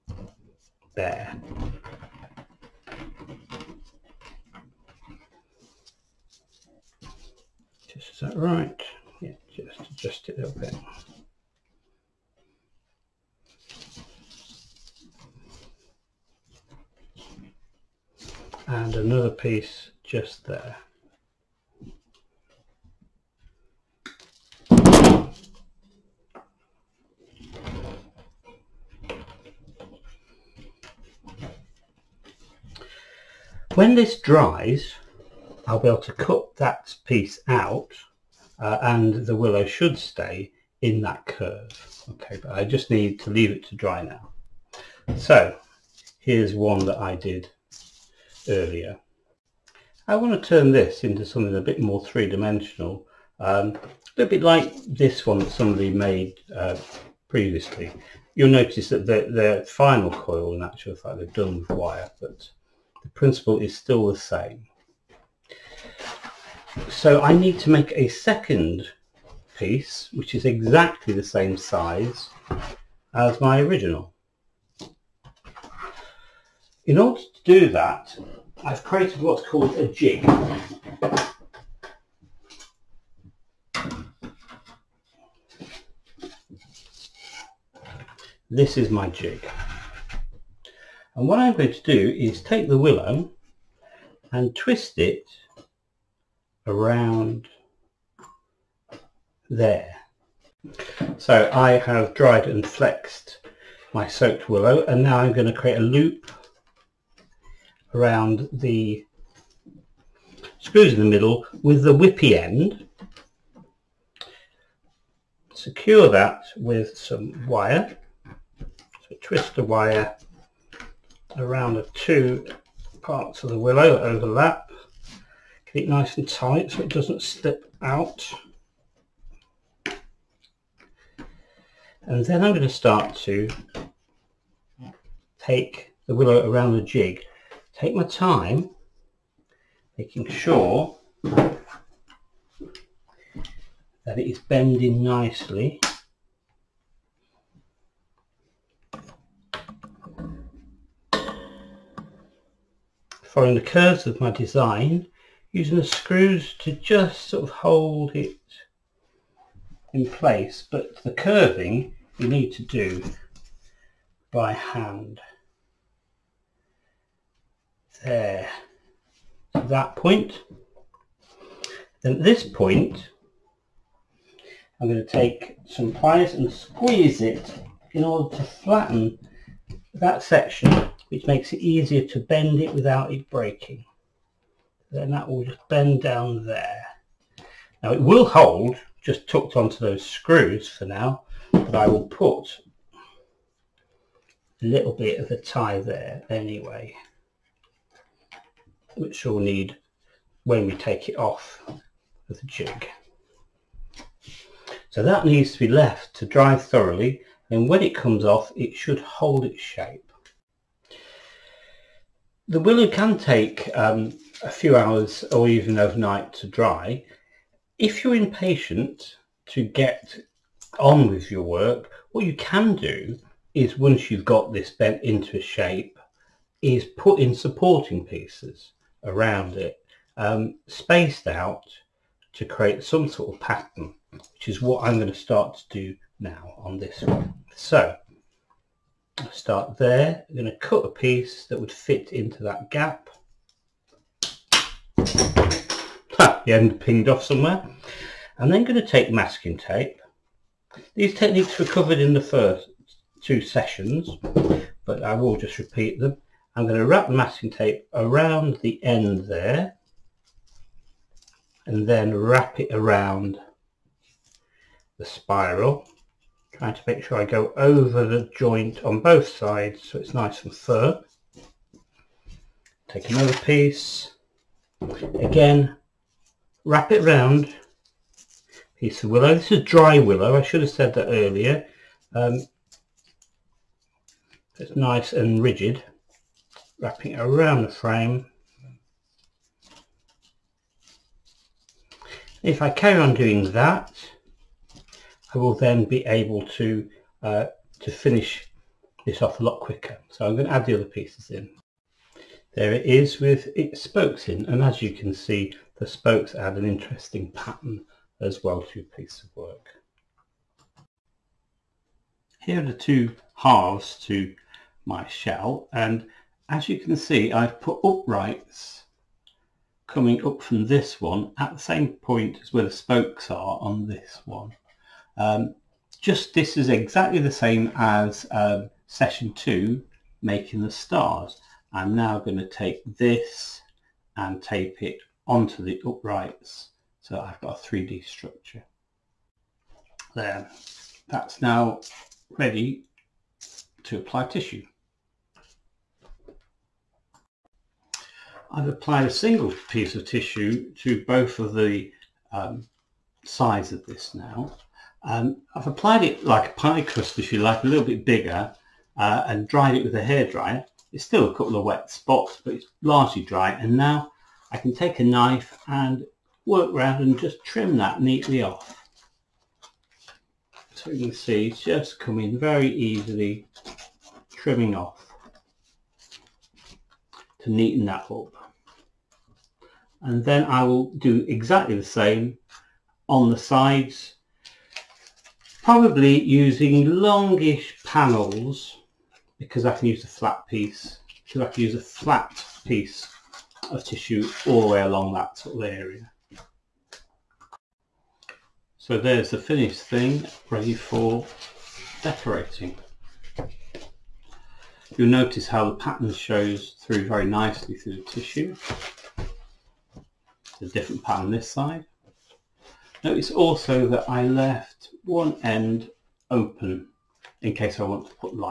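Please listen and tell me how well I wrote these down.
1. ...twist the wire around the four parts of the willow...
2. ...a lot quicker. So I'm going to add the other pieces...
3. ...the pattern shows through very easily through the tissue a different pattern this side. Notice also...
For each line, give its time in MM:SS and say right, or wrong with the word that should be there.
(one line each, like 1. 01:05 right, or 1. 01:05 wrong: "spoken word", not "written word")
1. 01:59 wrong: "two", not "four"
2. 04:59 right
3. 06:45 wrong: "nicely", not "easily".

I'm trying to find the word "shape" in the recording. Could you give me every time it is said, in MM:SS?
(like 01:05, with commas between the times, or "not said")
03:29, 03:45.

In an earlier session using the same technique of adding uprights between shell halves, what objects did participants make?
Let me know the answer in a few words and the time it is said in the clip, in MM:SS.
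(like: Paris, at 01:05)
Stars, at 05:30.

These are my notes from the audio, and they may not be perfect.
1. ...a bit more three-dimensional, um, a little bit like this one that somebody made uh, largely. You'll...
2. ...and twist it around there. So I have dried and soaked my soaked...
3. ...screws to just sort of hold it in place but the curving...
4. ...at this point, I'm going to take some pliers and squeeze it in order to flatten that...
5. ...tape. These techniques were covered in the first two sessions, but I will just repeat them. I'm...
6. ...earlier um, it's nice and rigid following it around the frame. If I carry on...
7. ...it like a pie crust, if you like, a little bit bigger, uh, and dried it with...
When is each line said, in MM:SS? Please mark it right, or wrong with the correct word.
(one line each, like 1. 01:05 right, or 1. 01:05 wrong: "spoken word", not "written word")
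1. 00:51 wrong: "previously", not "largely"
2. 01:34 wrong: "flexed", not "soaked"
3. 02:35 right
4. 02:52 right
5. 04:09 right
6. 04:41 wrong: "wrapping", not "following"
7. 05:56 right.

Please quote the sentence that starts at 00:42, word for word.
Okay, but I just need to leave it to dry now.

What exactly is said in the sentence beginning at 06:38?
So there's the finished thing ready for decorating.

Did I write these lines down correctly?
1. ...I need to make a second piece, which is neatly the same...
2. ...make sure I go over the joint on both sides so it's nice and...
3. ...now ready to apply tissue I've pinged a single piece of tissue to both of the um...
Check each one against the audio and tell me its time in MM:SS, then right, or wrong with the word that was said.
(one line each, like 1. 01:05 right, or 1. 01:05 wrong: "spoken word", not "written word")
1. 01:07 wrong: "exactly", not "neatly"
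2. 04:26 right
3. 05:41 wrong: "applied", not "pinged".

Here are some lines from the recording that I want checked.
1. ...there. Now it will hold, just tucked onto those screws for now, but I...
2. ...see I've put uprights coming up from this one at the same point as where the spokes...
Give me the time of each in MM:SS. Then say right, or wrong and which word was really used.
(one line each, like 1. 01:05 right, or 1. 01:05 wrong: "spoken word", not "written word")
1. 03:06 right
2. 05:16 right.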